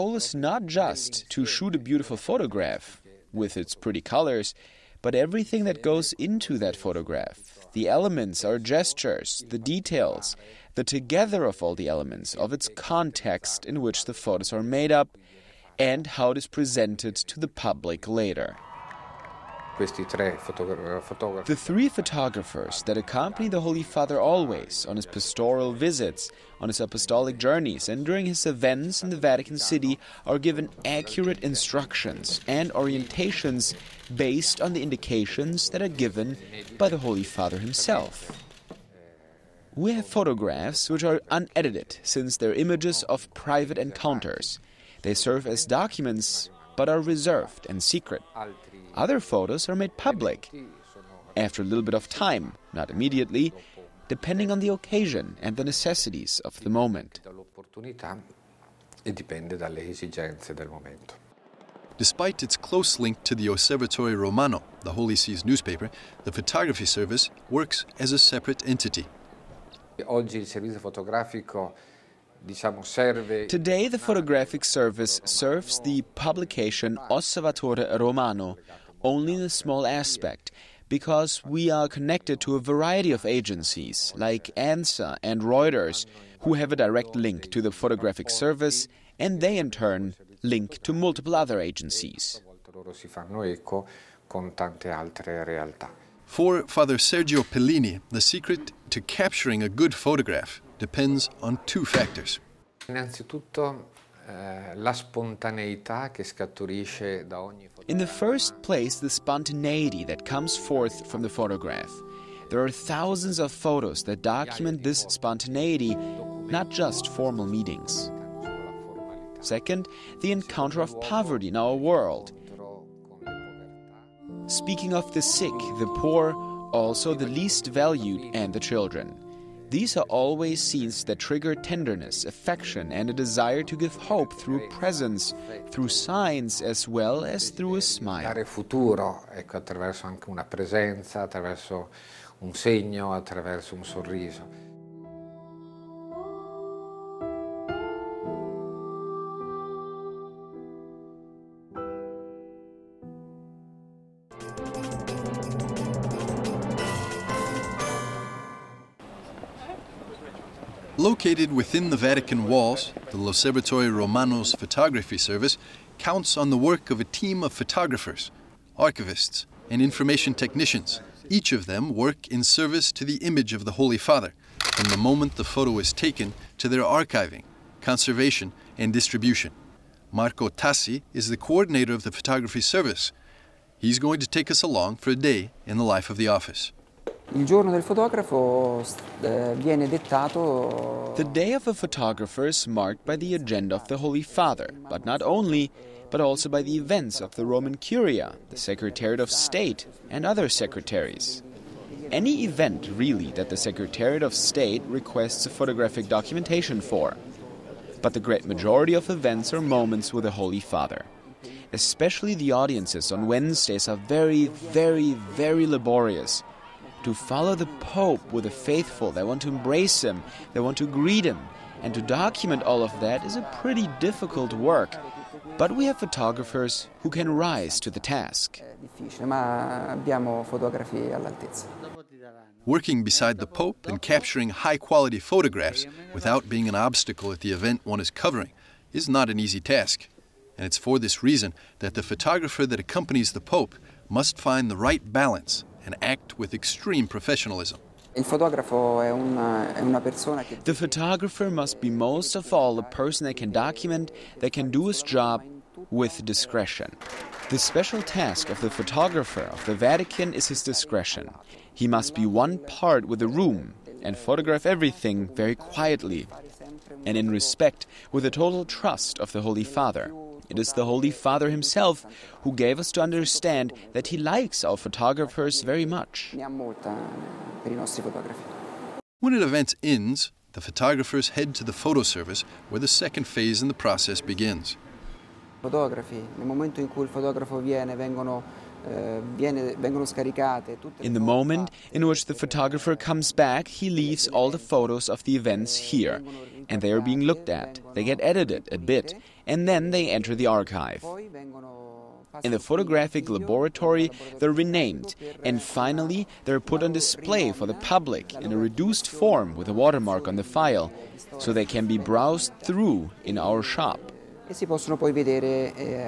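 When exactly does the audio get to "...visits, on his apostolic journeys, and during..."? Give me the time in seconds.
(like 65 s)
25 s.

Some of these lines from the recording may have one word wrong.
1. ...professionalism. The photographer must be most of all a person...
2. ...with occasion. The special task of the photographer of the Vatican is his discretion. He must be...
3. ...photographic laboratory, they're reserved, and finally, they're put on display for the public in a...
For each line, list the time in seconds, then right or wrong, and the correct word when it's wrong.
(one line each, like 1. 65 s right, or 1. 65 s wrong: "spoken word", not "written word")
1. 247 s right
2. 255 s wrong: "discretion", not "occasion"
3. 302 s wrong: "renamed", not "reserved".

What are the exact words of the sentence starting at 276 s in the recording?
When an event ends, the photographers head to the photo service where the second phase in the process begins.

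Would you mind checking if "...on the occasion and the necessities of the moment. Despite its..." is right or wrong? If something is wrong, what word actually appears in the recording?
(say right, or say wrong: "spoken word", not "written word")
right.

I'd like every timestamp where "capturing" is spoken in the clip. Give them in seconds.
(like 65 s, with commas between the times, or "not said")
99 s, 234 s.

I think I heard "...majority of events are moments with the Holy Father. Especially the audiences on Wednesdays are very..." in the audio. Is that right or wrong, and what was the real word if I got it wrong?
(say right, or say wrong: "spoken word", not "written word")
right.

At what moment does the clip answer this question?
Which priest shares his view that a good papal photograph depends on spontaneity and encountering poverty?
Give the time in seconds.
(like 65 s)
96 s.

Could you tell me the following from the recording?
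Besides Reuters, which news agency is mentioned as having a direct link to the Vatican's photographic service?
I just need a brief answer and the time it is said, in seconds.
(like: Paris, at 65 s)
ANSA, at 84 s.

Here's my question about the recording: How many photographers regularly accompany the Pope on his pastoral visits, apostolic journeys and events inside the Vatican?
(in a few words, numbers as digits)
3.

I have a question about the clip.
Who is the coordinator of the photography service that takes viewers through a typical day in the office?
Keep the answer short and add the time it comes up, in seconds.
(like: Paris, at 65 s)
Marco Tassi, at 180 s.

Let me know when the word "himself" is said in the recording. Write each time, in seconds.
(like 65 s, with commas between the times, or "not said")
37 s, 271 s.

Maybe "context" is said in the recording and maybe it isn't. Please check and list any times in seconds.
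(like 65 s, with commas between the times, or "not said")
12 s.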